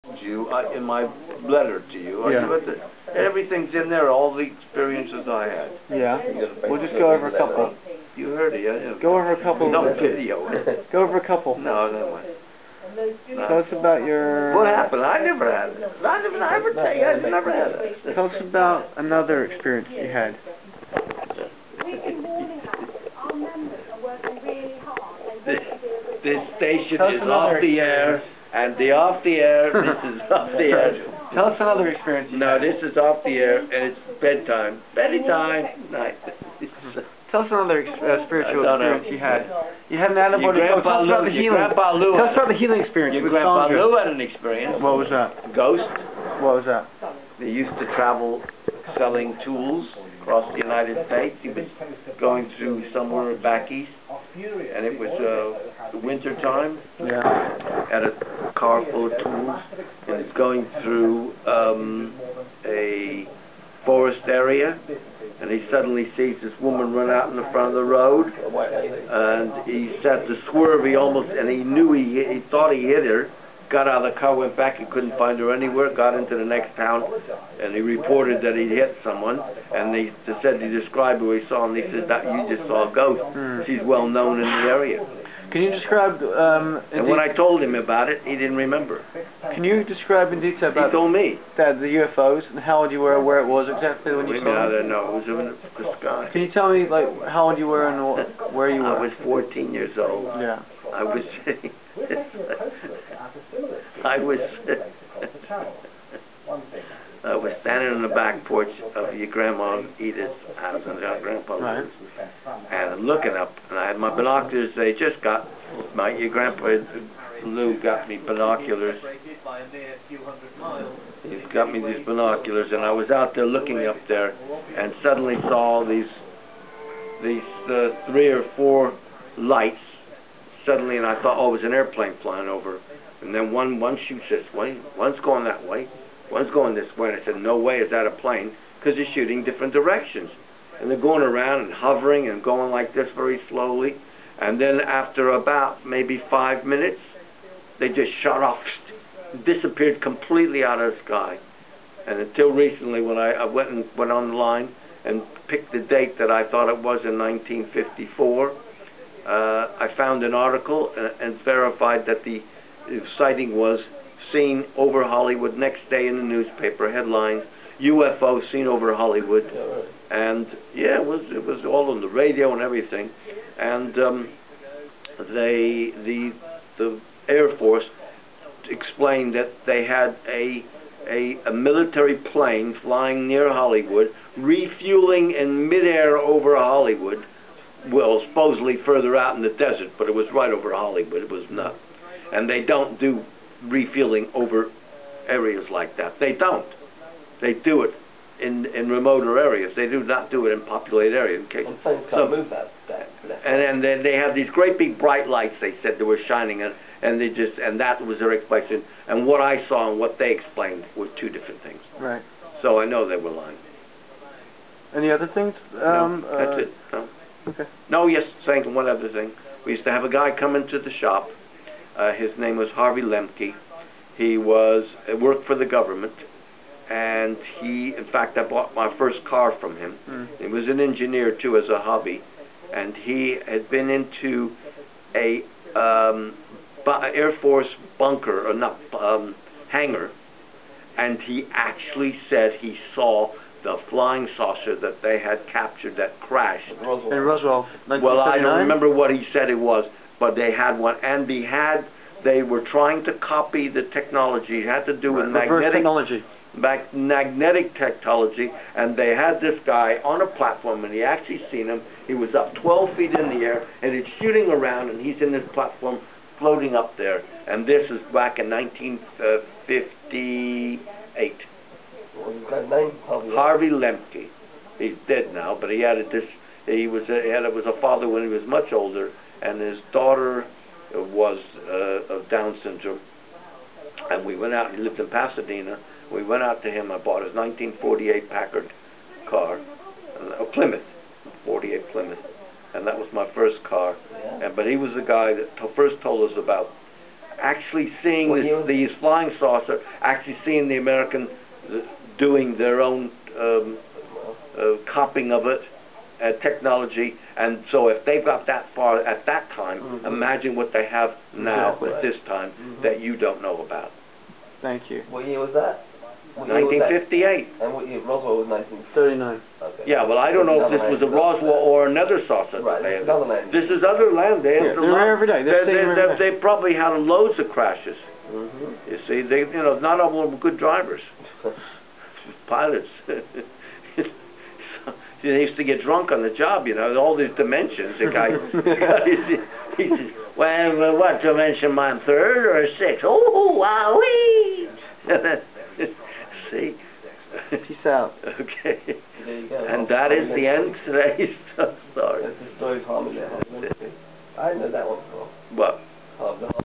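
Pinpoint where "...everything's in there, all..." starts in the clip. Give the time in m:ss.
0:03.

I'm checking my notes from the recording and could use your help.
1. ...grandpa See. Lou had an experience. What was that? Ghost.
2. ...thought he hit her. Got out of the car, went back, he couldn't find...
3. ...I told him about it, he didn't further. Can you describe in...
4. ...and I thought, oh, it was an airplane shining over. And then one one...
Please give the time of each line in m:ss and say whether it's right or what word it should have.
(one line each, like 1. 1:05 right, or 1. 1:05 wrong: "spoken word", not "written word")
1. 0:43 wrong: "Sandra", not "See"
2. 1:12 right
3. 1:27 wrong: "remember", not "further"
4. 2:10 wrong: "flying", not "shining".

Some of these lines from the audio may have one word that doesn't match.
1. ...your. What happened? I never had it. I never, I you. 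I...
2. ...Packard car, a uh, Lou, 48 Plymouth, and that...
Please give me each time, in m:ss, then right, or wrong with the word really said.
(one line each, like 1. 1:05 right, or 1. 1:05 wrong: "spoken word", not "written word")
1. 0:14 right
2. 4:48 wrong: "Plymouth", not "Lou".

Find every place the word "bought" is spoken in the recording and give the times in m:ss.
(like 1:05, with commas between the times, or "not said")
3:48, 4:46.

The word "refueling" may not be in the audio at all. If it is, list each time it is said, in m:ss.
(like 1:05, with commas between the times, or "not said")
3:04, 3:13.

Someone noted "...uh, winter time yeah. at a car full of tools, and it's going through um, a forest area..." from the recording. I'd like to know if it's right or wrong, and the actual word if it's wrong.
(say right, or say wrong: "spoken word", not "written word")
right.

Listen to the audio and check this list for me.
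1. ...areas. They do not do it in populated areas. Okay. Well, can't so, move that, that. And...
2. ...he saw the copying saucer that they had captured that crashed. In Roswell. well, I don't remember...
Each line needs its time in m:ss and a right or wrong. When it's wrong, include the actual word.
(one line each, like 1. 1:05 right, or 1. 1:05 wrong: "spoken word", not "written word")
1. 3:19 right
2. 4:02 wrong: "flying", not "copying".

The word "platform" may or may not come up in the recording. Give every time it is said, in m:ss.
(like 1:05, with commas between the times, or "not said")
4:20, 4:25.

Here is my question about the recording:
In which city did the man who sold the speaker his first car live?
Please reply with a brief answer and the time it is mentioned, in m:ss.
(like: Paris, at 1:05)
Pasadena, at 4:45.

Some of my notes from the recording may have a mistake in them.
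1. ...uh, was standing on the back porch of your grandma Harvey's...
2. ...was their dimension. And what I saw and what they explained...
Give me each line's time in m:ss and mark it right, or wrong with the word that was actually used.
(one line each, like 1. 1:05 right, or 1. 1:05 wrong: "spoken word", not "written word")
1. 1:47 wrong: "Edith", not "Harvey"
2. 3:28 wrong: "explanation", not "dimension".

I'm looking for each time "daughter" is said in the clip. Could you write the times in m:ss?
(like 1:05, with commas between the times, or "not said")
4:39.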